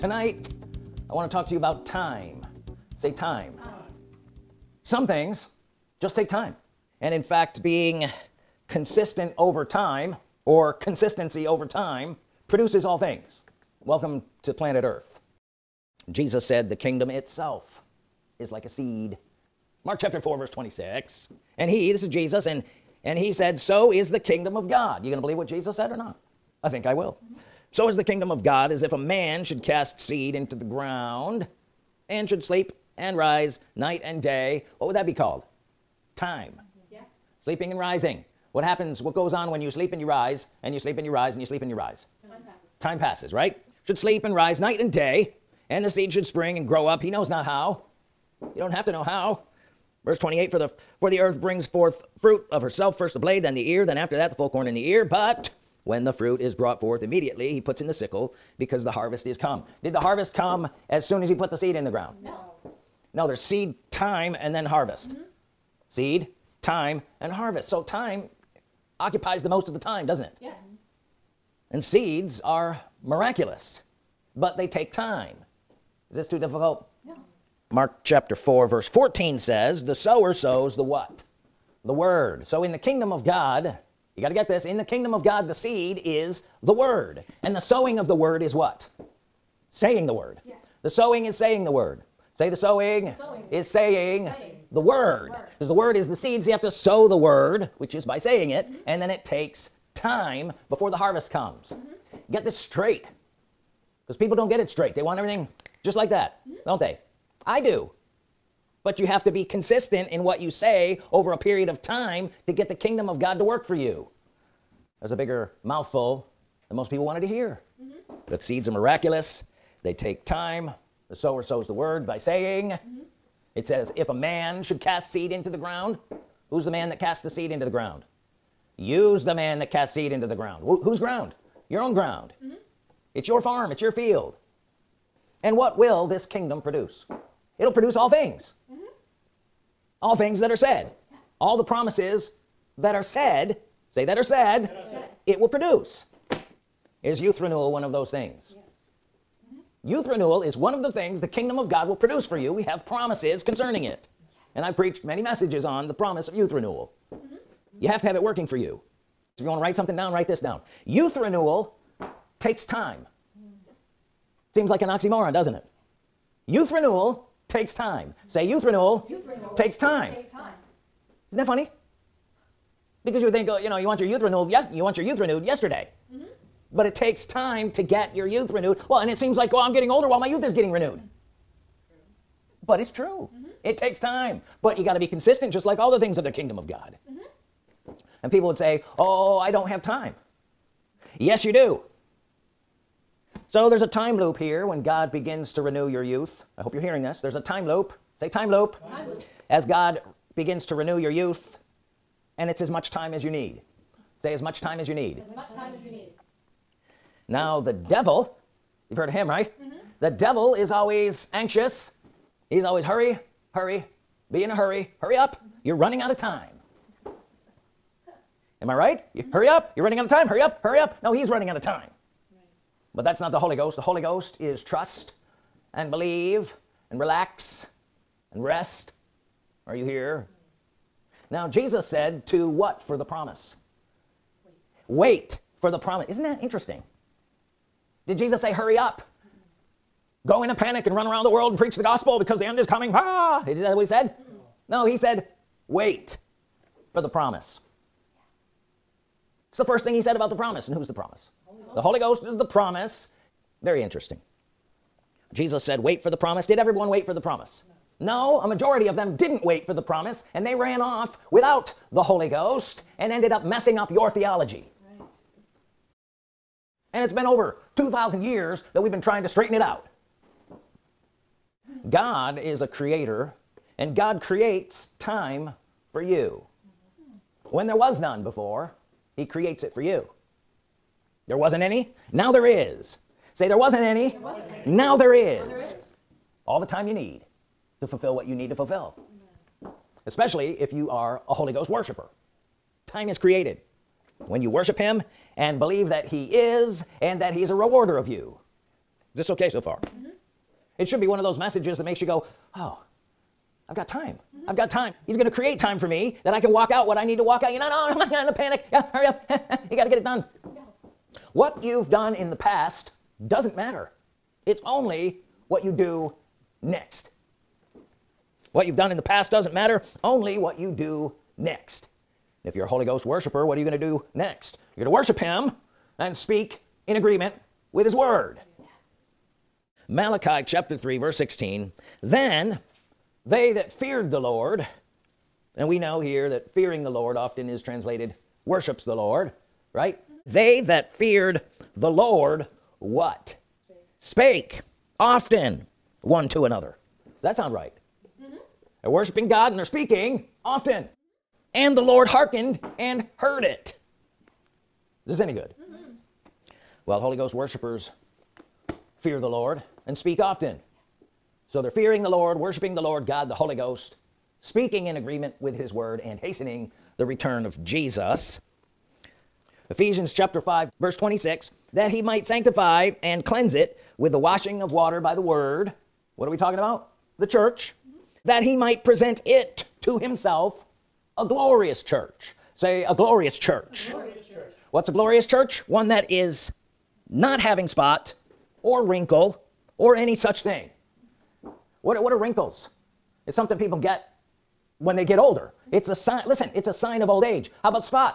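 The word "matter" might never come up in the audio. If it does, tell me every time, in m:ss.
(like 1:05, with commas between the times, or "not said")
5:13, 5:19.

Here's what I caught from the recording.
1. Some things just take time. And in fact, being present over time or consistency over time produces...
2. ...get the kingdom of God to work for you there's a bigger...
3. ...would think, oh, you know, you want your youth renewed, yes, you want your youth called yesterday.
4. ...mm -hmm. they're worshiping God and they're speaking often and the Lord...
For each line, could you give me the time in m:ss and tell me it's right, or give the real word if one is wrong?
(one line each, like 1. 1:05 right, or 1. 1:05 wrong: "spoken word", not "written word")
1. 0:04 wrong: "consistent", not "present"
2. 1:52 right
3. 2:53 wrong: "renewed", not "called"
4. 5:48 right.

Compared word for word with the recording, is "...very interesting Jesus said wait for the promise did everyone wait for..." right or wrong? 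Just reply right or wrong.
right.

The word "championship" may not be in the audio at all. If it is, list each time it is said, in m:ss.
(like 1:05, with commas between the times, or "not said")
not said.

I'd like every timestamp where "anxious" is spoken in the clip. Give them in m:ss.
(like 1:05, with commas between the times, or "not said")
3:31.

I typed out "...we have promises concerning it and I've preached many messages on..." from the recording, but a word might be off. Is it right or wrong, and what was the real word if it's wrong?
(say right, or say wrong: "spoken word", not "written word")
right.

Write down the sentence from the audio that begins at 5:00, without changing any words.
it should be one of those messages that makes you go oh I've got time mm -hmm.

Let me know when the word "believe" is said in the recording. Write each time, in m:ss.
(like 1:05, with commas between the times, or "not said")
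0:25, 3:45, 4:55.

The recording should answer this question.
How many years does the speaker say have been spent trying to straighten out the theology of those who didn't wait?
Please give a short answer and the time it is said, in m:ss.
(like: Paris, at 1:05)
2,000, at 4:27.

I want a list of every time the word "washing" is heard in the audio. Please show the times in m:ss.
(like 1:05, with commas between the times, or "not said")
6:14.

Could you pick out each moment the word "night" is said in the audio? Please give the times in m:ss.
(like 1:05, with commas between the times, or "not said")
0:33, 0:44.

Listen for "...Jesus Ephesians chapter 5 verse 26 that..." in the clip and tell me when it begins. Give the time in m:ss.
6:07.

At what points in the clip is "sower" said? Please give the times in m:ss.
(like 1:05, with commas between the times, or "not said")
1:19, 2:01.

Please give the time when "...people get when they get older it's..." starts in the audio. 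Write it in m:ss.
6:33.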